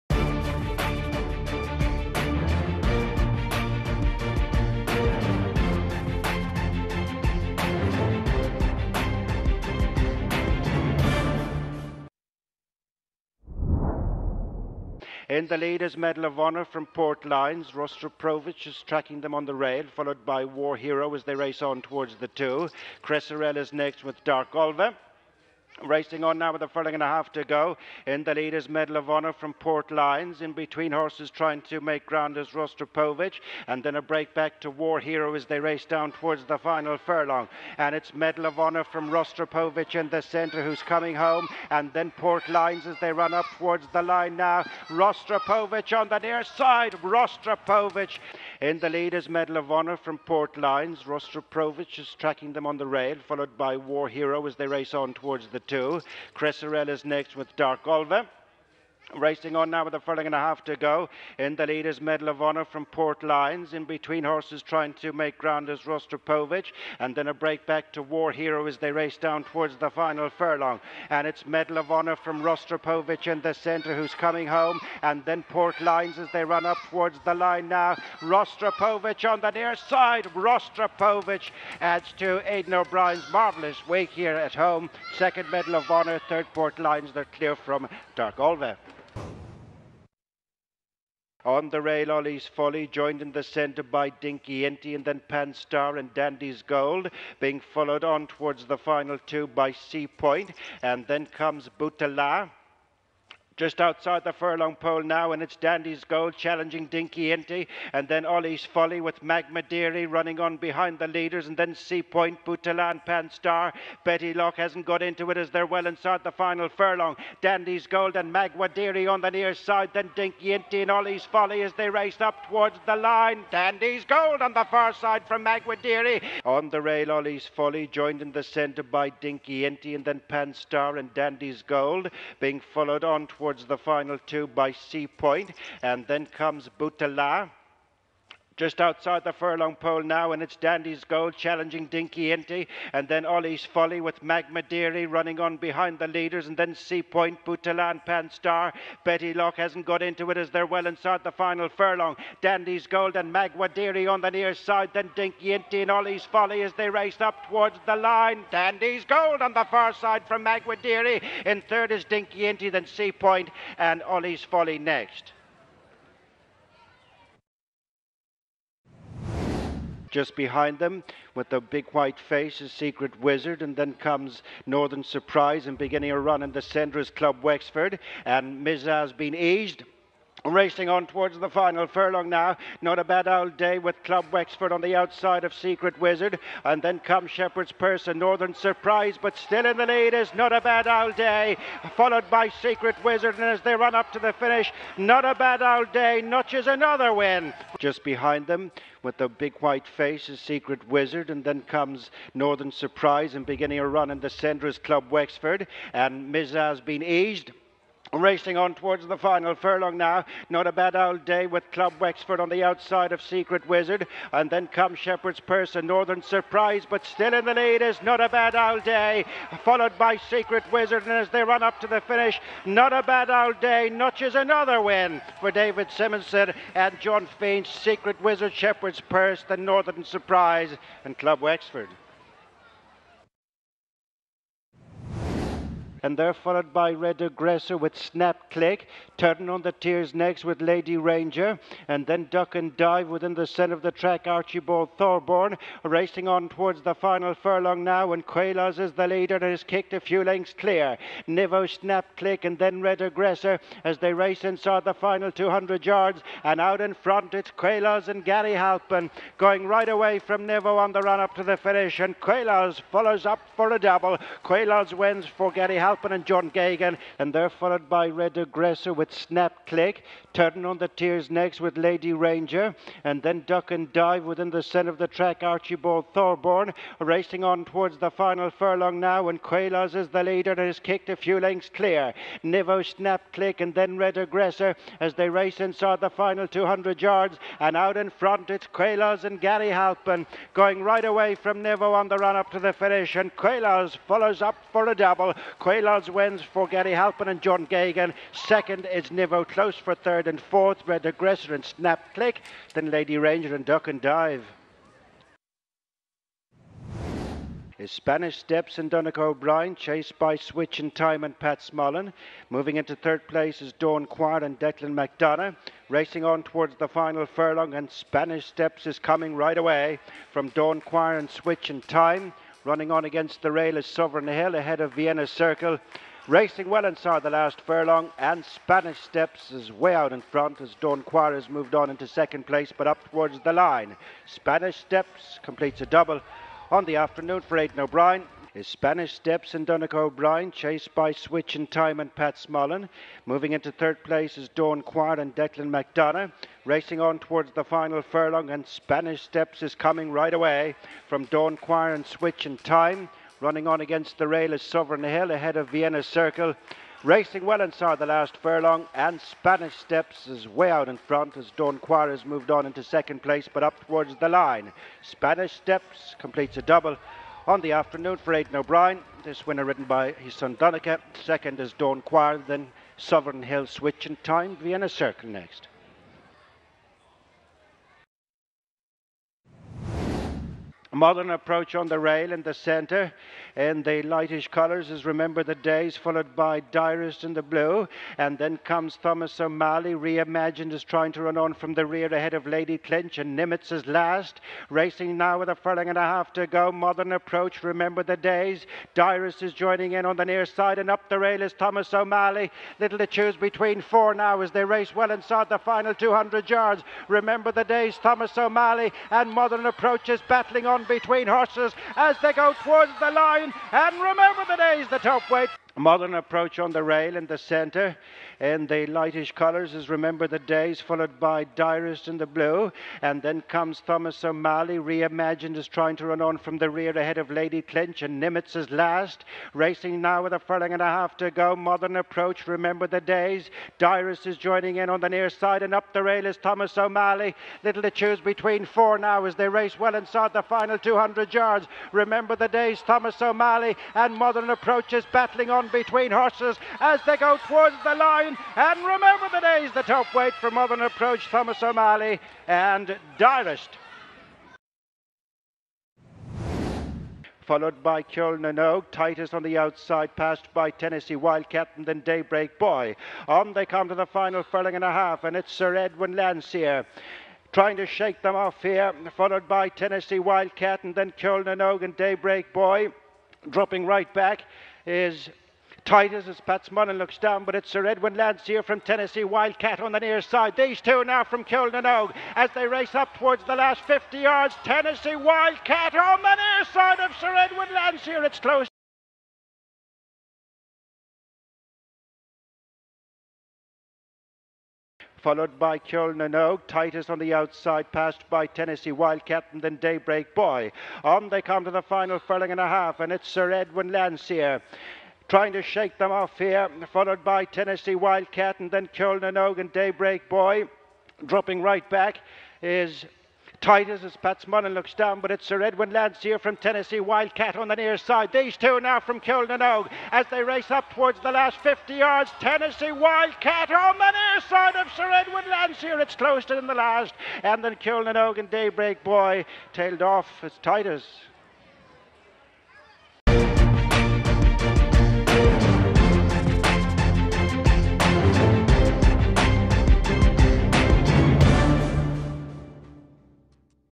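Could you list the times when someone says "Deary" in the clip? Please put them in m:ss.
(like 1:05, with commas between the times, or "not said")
1:49, 1:58, 2:05, 2:24, 2:33, 2:40.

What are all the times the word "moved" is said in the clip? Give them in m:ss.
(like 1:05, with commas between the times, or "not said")
5:31, 6:02.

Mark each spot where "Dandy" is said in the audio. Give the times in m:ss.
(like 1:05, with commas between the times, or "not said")
1:36, 1:45, 1:57, 2:03, 2:11, 2:20, 2:32, 2:38.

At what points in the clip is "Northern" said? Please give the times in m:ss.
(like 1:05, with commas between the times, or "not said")
2:54, 3:08, 3:22, 3:35, 3:49.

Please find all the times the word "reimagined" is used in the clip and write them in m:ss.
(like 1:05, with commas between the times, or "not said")
6:29, 7:04.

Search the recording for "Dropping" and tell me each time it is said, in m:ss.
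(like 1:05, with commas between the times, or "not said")
7:53, 8:31.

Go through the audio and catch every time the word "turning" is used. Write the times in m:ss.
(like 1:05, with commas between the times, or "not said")
3:59, 4:30.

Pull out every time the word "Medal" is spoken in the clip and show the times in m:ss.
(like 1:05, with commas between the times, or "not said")
0:15, 0:28, 0:38, 0:49, 1:01, 1:11, 1:25.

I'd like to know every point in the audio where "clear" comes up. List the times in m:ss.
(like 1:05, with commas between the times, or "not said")
1:27, 4:10, 4:41.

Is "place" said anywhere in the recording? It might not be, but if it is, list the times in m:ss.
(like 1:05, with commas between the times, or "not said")
5:13, 5:32, 5:44, 6:03.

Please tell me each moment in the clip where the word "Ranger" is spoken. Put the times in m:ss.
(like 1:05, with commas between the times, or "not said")
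4:00, 4:32, 5:03.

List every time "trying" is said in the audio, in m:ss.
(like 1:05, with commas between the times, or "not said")
0:31, 1:04, 6:30, 7:05, 7:47, 8:25.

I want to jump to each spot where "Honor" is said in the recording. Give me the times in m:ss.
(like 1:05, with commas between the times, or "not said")
0:16, 0:29, 0:38, 0:49, 1:02, 1:11, 1:25.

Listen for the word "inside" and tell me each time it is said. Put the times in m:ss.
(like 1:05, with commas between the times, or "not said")
1:55, 2:30, 4:14, 4:45, 5:26, 5:57, 6:45, 7:19.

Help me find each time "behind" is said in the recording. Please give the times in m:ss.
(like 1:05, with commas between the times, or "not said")
1:50, 2:25, 2:50, 3:18.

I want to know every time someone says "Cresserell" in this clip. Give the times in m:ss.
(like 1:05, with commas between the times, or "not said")
0:23, 0:56.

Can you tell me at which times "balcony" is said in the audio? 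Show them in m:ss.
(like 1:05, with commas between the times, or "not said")
not said.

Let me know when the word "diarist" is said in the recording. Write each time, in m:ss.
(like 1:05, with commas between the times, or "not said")
6:26, 6:38, 7:01, 7:13, 7:33.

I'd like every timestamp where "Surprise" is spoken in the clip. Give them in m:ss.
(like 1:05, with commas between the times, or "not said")
2:55, 3:08, 3:22, 3:36, 3:50.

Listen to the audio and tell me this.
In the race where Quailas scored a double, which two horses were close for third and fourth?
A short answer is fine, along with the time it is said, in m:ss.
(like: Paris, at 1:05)
Red Aggressor and Snap Click, at 5:00.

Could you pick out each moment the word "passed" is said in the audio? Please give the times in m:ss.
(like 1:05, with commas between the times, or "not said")
7:40, 8:17.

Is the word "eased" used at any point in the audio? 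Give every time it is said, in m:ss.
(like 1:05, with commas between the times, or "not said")
2:59, 3:27.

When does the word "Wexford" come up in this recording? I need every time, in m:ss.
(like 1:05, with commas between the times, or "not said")
2:57, 3:04, 3:25, 3:31, 3:51.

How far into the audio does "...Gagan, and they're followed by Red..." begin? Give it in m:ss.
4:26.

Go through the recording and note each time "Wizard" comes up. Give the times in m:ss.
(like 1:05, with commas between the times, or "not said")
2:53, 3:06, 3:13, 3:20, 3:33, 3:40, 3:48.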